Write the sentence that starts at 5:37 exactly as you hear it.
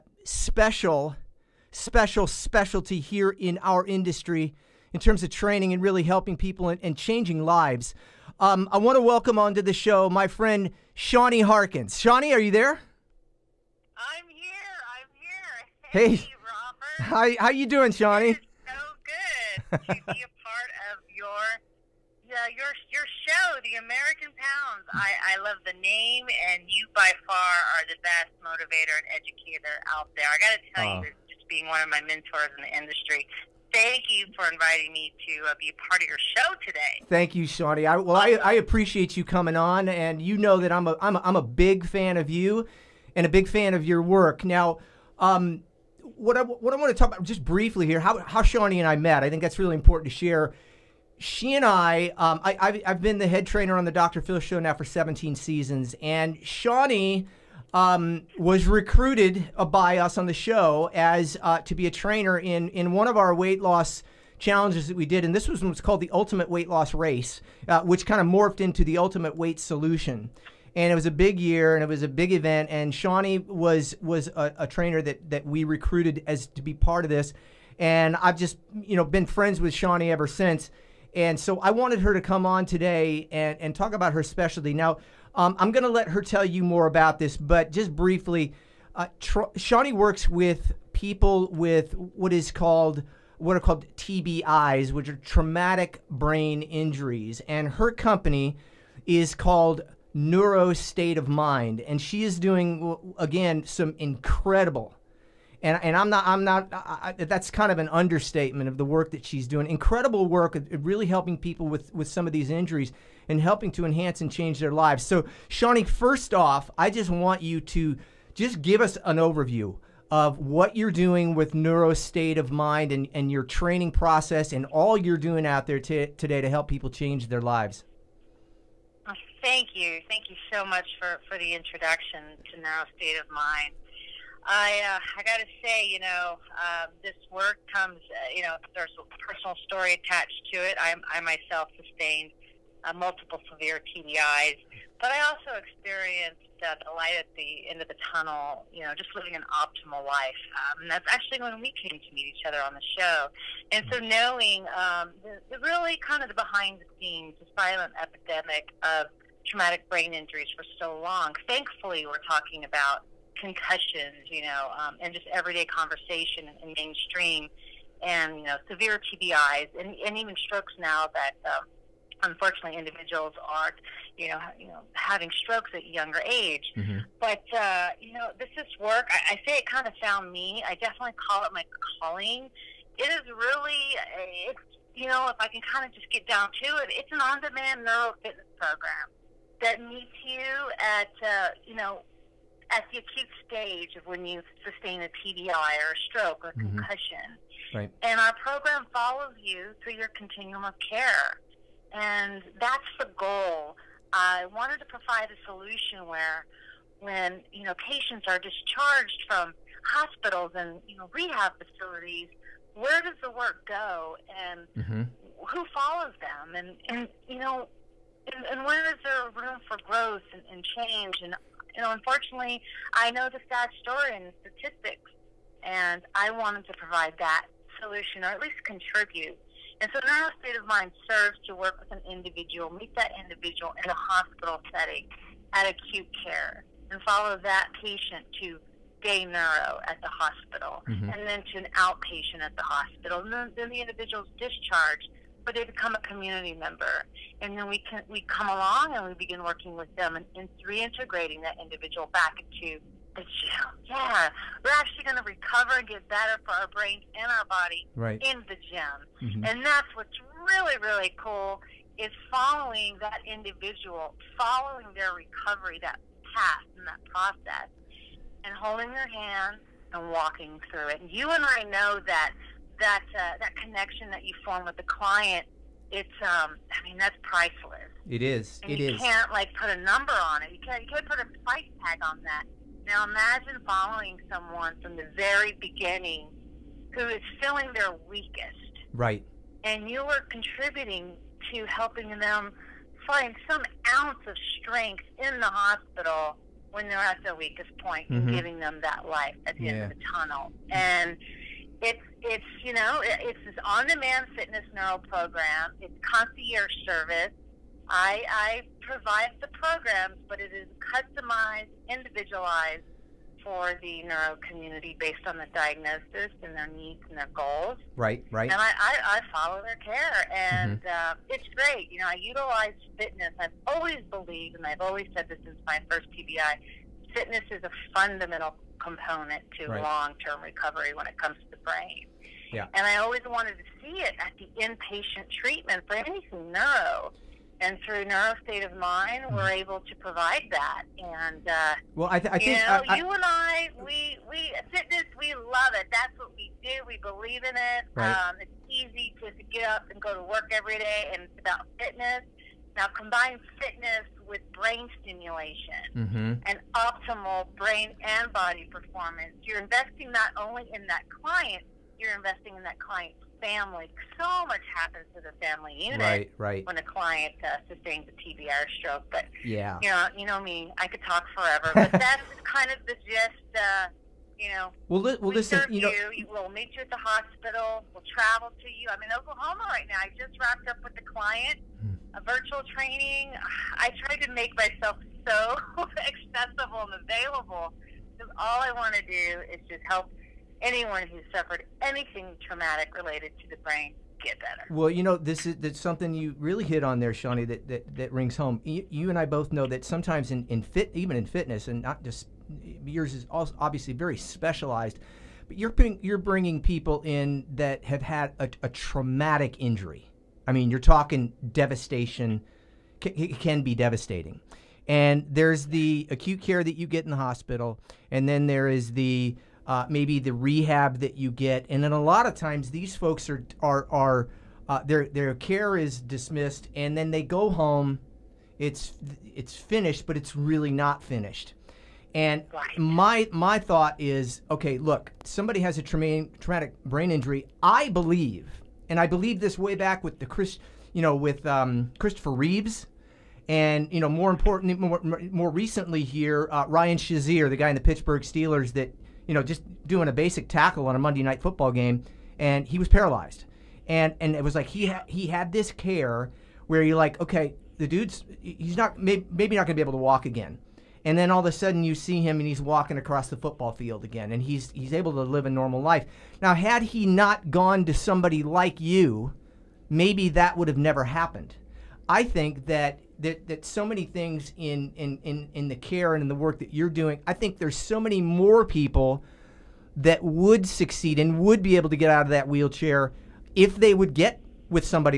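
And through Neuro State of Mind, we're mm-hmm.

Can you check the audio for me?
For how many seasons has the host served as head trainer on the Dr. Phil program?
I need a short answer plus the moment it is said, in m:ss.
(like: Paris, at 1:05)
17, at 0:54.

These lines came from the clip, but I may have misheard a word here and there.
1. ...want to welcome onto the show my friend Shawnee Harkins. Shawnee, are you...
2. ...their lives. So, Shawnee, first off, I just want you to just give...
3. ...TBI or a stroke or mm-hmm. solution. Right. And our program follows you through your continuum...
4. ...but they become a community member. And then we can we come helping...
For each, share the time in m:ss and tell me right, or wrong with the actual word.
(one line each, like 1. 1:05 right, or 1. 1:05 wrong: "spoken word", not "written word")
1. 0:08 right
2. 1:54 right
3. 3:15 wrong: "concussion", not "solution"
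4. 4:05 wrong: "along", not "helping".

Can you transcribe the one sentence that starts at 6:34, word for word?
Well, you know, this is that's something you really hit on there, Shawnee, that, that, that rings home.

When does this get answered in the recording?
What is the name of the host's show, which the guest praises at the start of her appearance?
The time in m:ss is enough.
0:23.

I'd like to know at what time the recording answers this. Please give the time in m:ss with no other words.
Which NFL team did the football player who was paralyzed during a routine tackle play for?
7:27.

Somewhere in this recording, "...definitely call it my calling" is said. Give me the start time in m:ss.
3:00.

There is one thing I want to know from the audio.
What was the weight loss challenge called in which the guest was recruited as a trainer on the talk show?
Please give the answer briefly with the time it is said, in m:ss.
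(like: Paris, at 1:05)
Ultimate Weight Loss Race, at 1:06.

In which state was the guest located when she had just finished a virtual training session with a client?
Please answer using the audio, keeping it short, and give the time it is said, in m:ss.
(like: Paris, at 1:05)
Oklahoma, at 6:19.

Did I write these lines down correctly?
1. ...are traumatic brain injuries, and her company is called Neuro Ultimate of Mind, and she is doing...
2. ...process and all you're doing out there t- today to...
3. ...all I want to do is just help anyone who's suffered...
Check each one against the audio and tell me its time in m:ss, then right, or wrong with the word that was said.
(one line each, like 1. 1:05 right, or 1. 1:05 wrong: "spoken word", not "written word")
1. 1:35 wrong: "State", not "Ultimate"
2. 2:03 right
3. 6:28 right.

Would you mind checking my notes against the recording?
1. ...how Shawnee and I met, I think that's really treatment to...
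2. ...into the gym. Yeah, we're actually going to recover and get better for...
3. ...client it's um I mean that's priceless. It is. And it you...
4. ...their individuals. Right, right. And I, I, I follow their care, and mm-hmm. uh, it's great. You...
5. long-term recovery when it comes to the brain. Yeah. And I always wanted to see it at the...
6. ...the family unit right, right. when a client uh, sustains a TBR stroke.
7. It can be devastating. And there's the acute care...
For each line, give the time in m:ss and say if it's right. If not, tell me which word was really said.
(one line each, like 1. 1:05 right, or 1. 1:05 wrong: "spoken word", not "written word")
1. 0:48 wrong: "important", not "treatment"
2. 4:12 right
3. 4:34 right
4. 5:17 wrong: "goals", not "individuals"
5. 5:29 right
6. 6:05 right
7. 6:53 right.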